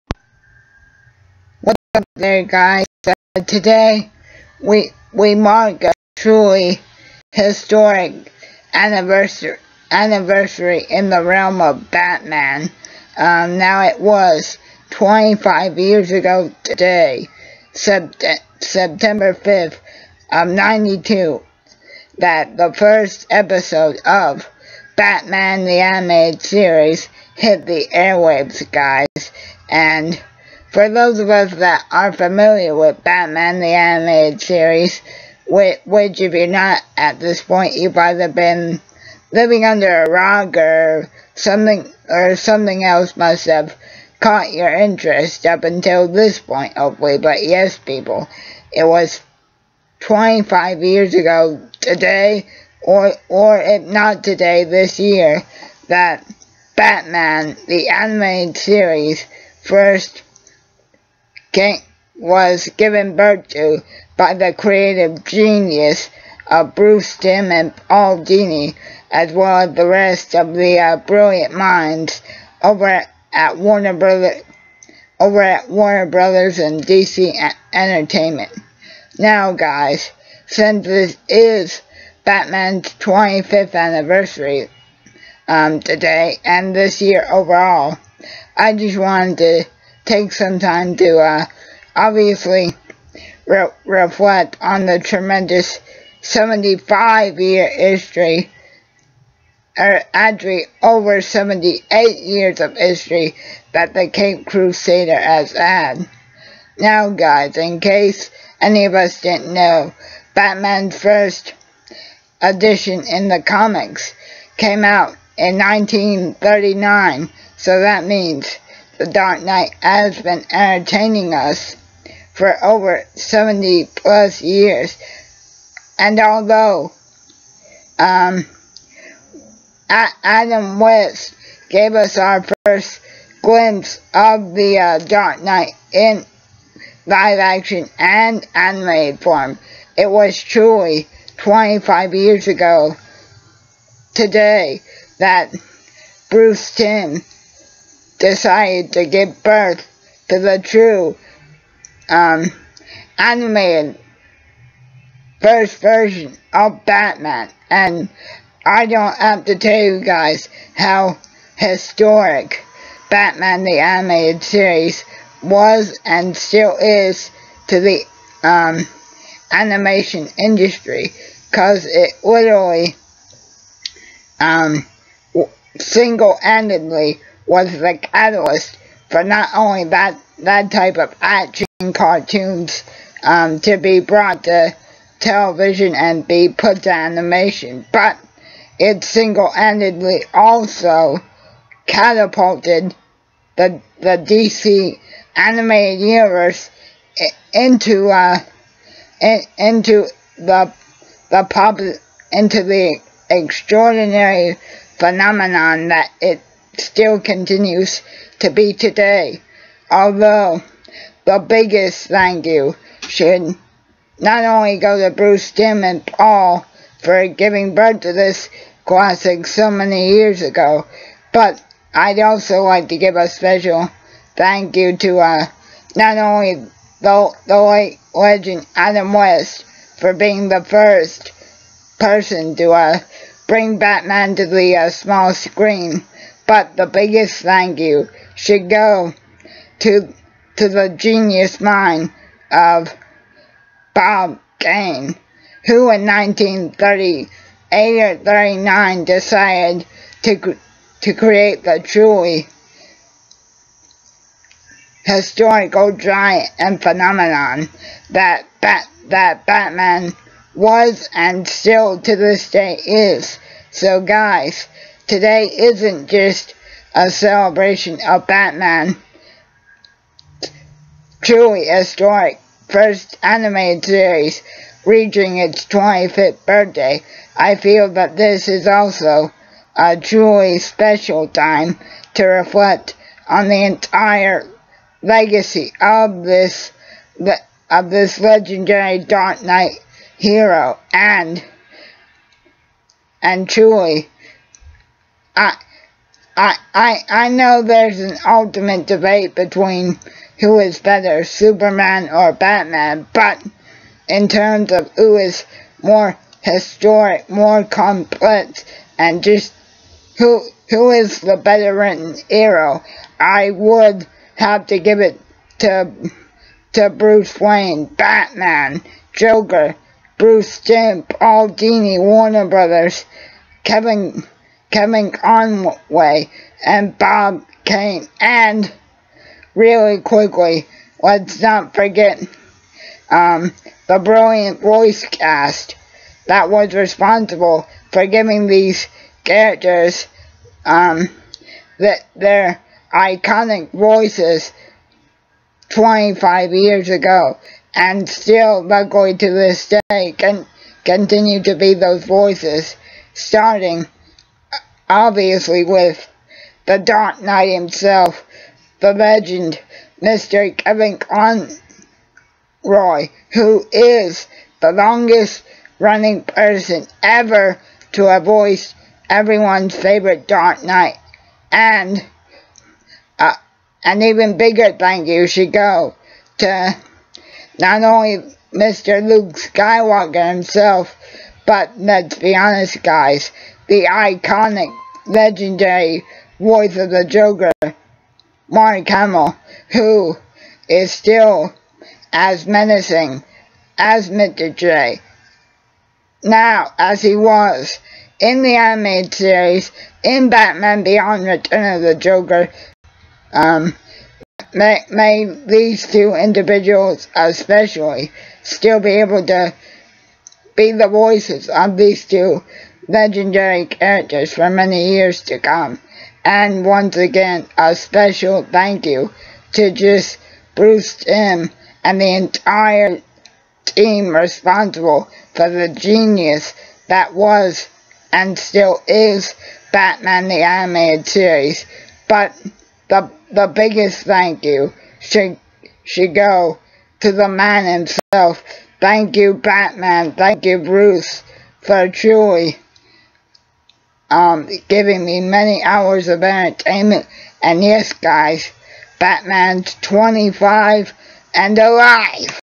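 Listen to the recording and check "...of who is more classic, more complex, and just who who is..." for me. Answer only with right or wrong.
wrong.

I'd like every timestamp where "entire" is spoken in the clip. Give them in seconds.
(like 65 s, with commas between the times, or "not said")
283 s, 422 s.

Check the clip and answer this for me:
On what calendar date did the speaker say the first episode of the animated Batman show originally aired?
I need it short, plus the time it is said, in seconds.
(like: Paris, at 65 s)
September 5th, at 18 s.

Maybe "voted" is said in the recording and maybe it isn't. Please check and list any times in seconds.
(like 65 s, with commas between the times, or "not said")
not said.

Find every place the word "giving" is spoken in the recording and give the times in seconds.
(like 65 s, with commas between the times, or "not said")
217 s, 338 s, 444 s.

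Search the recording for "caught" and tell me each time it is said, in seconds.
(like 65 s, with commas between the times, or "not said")
44 s.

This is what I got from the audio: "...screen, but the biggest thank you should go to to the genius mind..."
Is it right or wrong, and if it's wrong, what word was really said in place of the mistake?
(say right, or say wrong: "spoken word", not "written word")
right.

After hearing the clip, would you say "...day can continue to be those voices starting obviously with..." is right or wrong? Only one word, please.
right.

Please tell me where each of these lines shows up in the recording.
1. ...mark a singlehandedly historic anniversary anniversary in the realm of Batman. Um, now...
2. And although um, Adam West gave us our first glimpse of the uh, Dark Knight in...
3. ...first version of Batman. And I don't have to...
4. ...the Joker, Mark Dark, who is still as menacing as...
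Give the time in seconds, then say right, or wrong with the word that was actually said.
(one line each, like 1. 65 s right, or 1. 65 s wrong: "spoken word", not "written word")
1. 5 s wrong: "truly", not "singlehandedly"
2. 125 s right
3. 155 s right
4. 386 s wrong: "Hamill", not "Dark".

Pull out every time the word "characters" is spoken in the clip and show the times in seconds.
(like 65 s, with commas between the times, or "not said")
339 s, 413 s.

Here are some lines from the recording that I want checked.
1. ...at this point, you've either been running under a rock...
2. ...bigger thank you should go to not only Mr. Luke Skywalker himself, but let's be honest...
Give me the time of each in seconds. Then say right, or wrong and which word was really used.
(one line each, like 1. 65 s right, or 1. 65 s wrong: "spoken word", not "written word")
1. 36 s wrong: "living", not "running"
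2. 374 s right.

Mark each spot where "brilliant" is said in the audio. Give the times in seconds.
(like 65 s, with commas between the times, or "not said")
70 s, 333 s.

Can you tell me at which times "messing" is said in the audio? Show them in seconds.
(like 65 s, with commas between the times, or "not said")
not said.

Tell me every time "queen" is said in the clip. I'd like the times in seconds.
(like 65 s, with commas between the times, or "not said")
not said.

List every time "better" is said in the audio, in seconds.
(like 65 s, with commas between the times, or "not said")
300 s, 311 s.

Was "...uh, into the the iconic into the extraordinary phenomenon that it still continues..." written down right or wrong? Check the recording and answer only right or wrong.
wrong.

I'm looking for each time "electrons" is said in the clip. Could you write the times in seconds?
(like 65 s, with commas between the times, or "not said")
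not said.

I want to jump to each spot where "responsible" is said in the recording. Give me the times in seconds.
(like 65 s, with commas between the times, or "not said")
336 s, 424 s.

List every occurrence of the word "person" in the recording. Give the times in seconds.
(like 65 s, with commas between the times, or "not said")
231 s, 366 s.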